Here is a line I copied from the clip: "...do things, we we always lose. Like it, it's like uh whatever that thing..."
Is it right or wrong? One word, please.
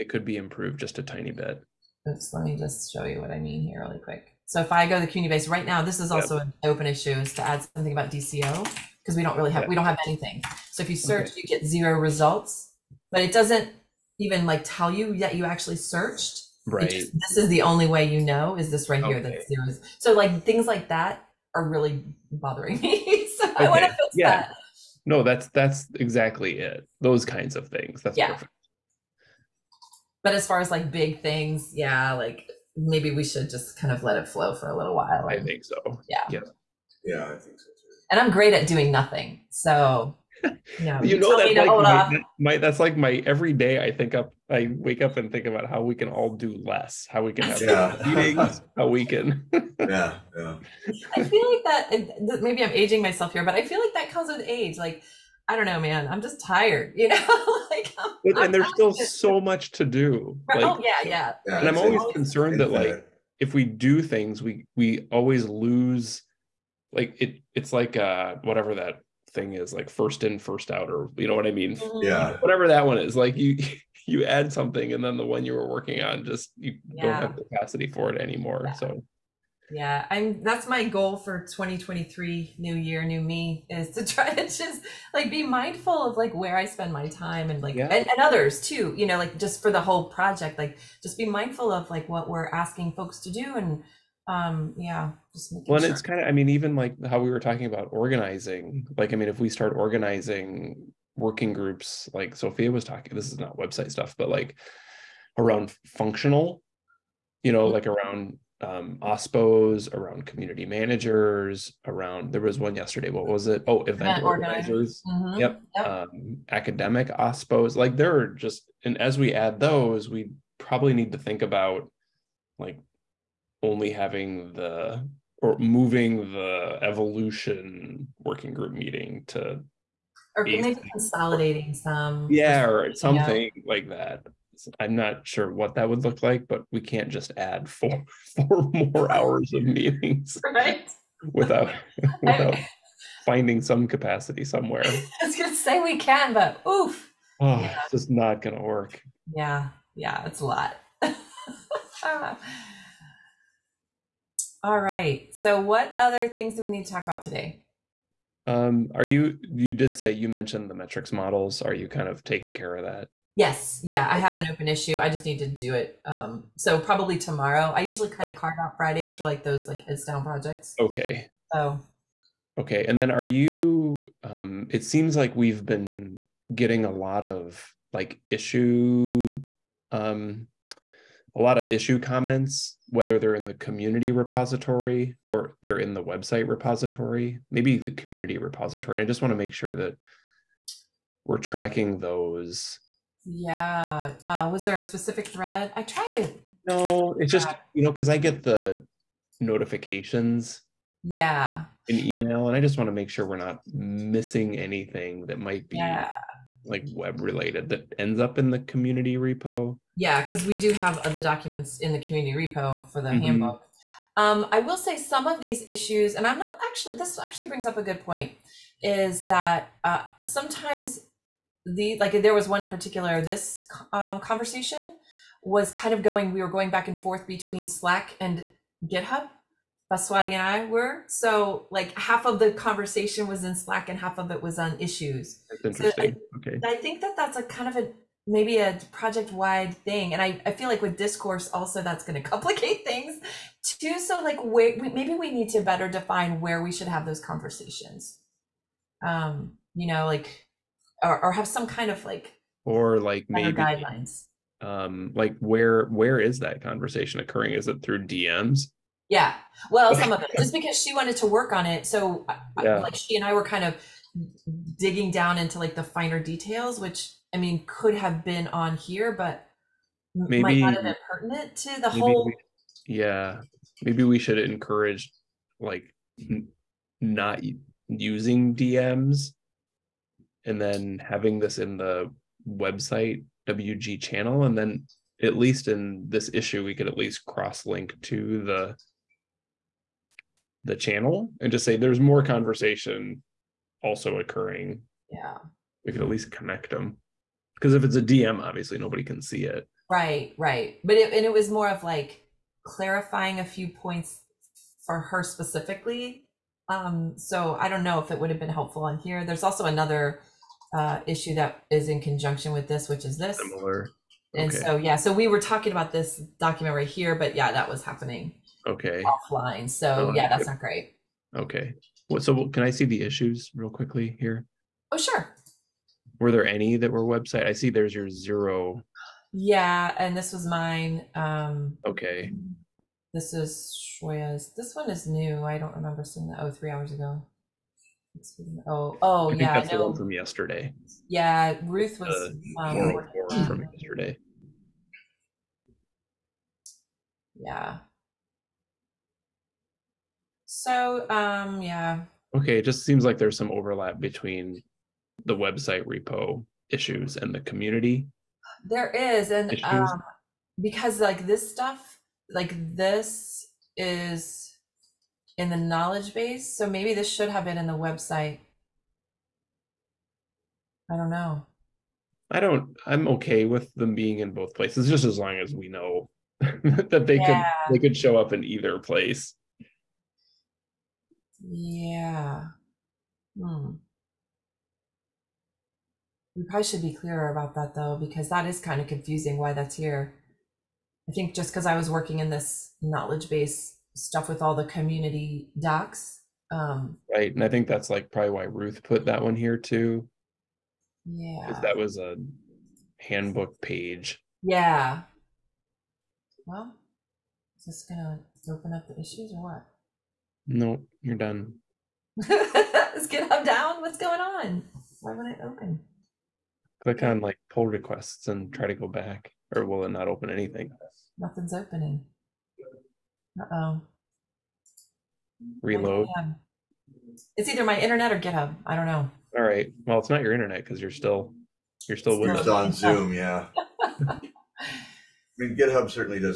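right.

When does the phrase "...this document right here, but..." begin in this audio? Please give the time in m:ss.
5:15.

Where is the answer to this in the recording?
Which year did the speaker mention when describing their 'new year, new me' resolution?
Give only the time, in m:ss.
1:21.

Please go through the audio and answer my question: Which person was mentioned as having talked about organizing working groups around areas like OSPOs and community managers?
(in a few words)
Sophia.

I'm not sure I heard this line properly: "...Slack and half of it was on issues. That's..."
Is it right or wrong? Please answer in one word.
right.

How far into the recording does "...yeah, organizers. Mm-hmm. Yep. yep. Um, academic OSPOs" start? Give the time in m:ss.
1:54.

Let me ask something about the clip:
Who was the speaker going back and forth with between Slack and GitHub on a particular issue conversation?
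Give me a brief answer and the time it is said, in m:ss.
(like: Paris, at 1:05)
Baswati, at 3:49.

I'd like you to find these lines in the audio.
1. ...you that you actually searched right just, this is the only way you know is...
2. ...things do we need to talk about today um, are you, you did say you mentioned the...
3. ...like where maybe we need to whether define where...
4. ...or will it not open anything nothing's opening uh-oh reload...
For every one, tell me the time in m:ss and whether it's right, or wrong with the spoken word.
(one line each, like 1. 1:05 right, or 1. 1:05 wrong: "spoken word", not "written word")
1. 0:14 right
2. 2:36 right
3. 4:04 wrong: "better", not "whether"
4. 6:59 right.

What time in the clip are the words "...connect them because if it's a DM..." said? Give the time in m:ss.
4:56.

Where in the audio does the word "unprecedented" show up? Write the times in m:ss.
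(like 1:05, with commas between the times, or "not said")
not said.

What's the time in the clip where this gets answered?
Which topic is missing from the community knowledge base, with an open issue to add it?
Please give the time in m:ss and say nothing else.
0:08.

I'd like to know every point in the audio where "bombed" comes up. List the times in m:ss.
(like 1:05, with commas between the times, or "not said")
not said.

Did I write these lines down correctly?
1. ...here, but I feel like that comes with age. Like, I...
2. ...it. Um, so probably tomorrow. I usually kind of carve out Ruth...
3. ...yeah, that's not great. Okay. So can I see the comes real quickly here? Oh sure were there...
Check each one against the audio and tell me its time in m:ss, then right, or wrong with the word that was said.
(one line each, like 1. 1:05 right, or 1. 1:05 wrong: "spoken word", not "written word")
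1. 0:53 right
2. 2:45 wrong: "Fridays", not "Ruth"
3. 5:20 wrong: "issues", not "comes".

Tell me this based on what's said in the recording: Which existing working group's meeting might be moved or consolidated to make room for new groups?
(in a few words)
evolution working group.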